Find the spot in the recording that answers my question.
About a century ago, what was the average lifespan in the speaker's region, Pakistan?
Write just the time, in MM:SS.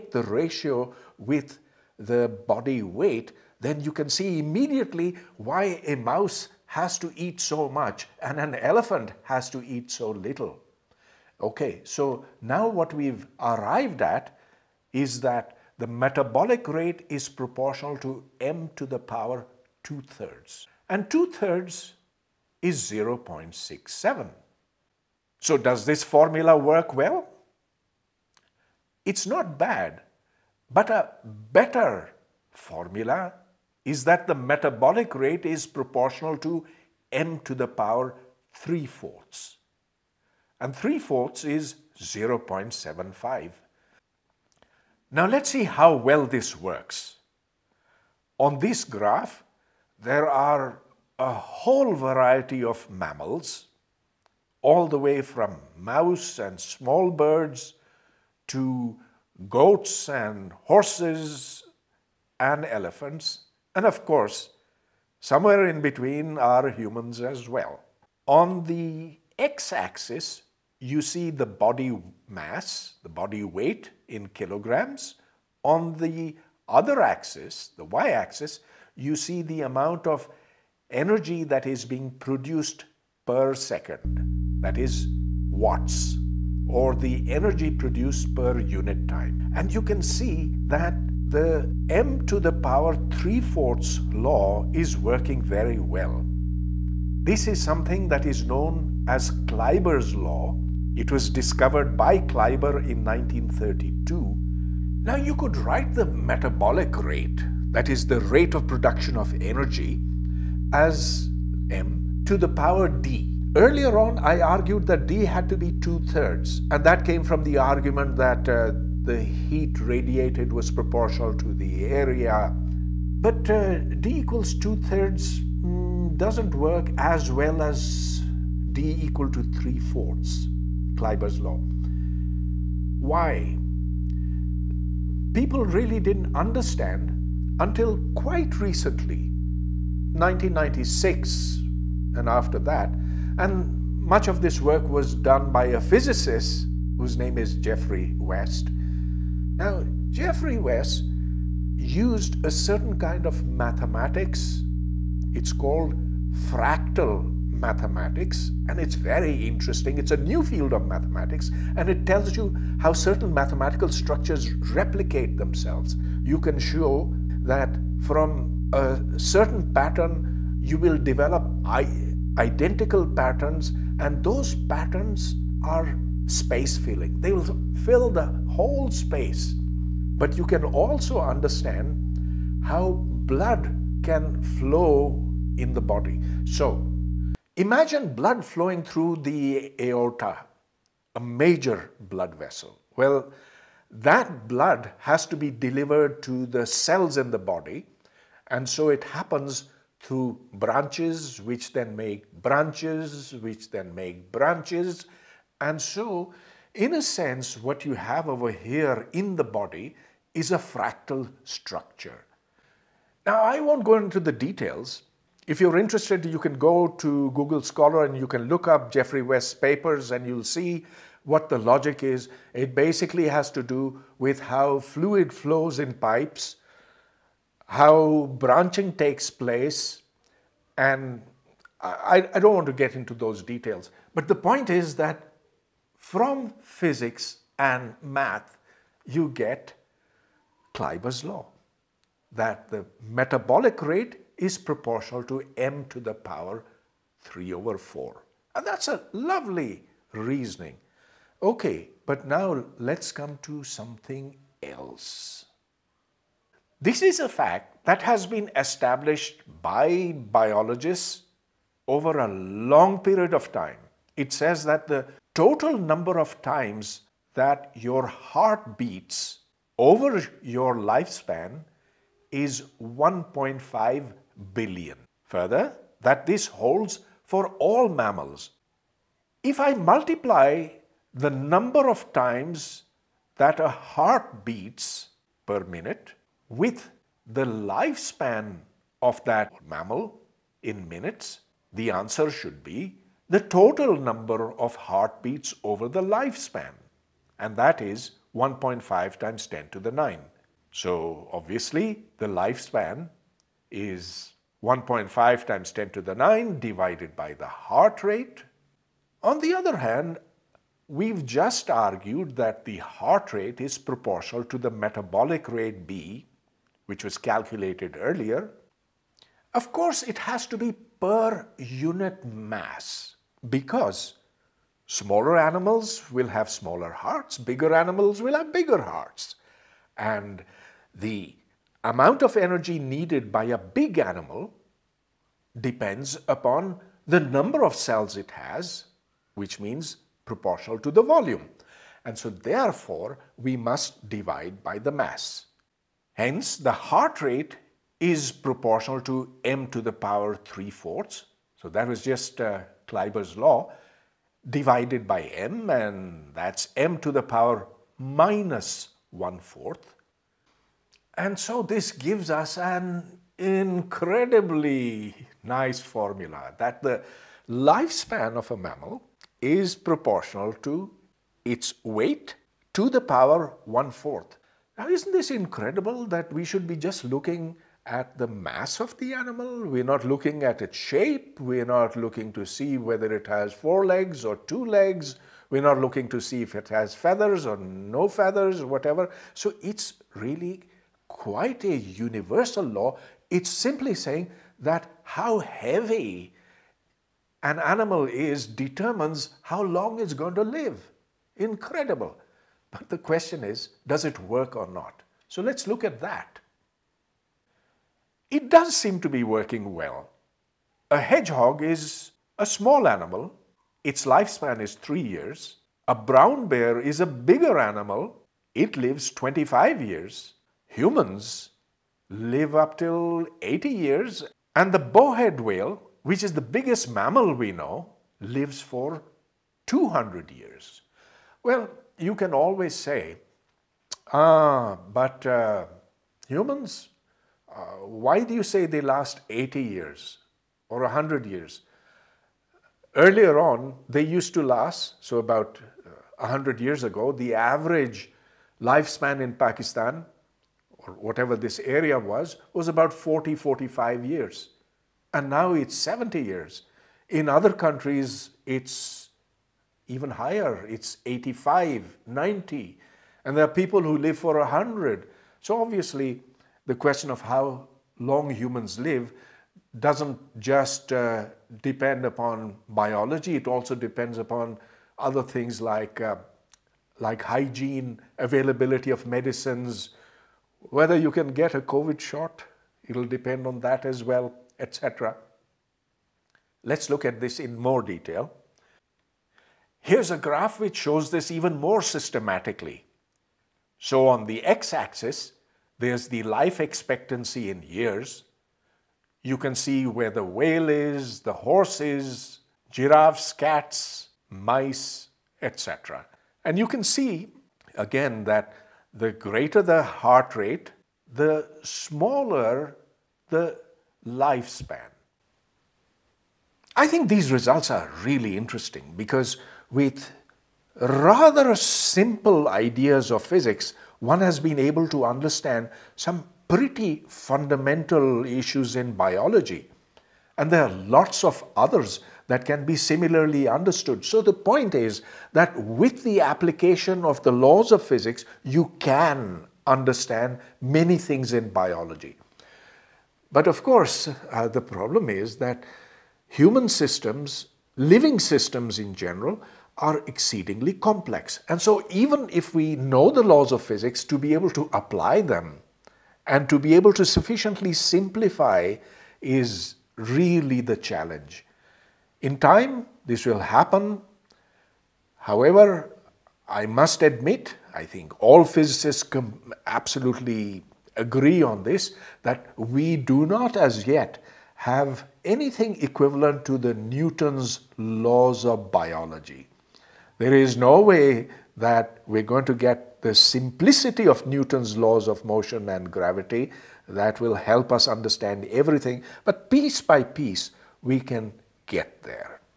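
07:32.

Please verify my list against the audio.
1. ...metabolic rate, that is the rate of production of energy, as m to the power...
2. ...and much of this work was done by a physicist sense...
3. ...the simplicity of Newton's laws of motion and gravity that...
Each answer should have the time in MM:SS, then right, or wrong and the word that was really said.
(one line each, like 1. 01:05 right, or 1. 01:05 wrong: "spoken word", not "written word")
1. 01:46 right
2. 02:23 wrong: "whose", not "sense"
3. 09:43 right.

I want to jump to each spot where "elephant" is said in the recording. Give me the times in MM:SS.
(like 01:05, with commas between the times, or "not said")
00:08, 01:02.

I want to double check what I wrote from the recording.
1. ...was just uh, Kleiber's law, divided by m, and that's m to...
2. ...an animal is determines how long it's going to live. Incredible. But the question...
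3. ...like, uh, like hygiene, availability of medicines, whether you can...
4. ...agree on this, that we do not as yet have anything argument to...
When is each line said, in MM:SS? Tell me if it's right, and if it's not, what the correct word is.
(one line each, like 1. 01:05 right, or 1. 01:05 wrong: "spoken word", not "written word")
1. 05:51 right
2. 06:37 right
3. 07:55 right
4. 09:30 wrong: "equivalent", not "argument".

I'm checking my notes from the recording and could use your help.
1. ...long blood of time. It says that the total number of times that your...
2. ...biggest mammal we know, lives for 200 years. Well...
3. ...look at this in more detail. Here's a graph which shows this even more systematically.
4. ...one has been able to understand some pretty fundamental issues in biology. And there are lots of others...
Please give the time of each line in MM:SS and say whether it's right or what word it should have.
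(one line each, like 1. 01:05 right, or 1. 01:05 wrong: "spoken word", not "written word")
1. 04:22 wrong: "period", not "blood"
2. 07:06 right
3. 08:06 right
4. 08:44 right.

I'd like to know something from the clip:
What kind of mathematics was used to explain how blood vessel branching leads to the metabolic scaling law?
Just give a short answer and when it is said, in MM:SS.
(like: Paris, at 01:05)
Fractal mathematics, at 02:36.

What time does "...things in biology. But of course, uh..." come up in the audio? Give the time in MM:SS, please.
09:00.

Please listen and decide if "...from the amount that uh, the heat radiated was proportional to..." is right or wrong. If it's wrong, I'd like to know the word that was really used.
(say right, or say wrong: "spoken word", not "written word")
wrong: "argument", not "amount".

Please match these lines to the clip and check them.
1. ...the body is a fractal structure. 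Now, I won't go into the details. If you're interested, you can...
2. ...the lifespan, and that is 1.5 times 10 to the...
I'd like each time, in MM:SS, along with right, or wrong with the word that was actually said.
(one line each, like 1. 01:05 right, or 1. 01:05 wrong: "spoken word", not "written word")
1. 03:29 right
2. 04:55 right.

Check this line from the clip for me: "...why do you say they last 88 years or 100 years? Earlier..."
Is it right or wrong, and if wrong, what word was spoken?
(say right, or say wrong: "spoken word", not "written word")
wrong: "80", not "88".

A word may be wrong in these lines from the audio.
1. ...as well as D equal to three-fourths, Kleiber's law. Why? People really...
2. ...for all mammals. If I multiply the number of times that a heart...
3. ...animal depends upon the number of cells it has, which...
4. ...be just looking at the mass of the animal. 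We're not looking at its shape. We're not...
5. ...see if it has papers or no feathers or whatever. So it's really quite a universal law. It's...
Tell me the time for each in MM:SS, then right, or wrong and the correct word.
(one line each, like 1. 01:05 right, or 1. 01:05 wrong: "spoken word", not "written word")
1. 02:06 right
2. 04:37 right
3. 05:33 right
4. 06:16 right
5. 06:26 wrong: "feathers", not "papers".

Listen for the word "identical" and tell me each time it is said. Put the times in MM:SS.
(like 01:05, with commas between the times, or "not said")
02:52.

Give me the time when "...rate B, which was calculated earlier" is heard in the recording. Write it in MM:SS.
05:15.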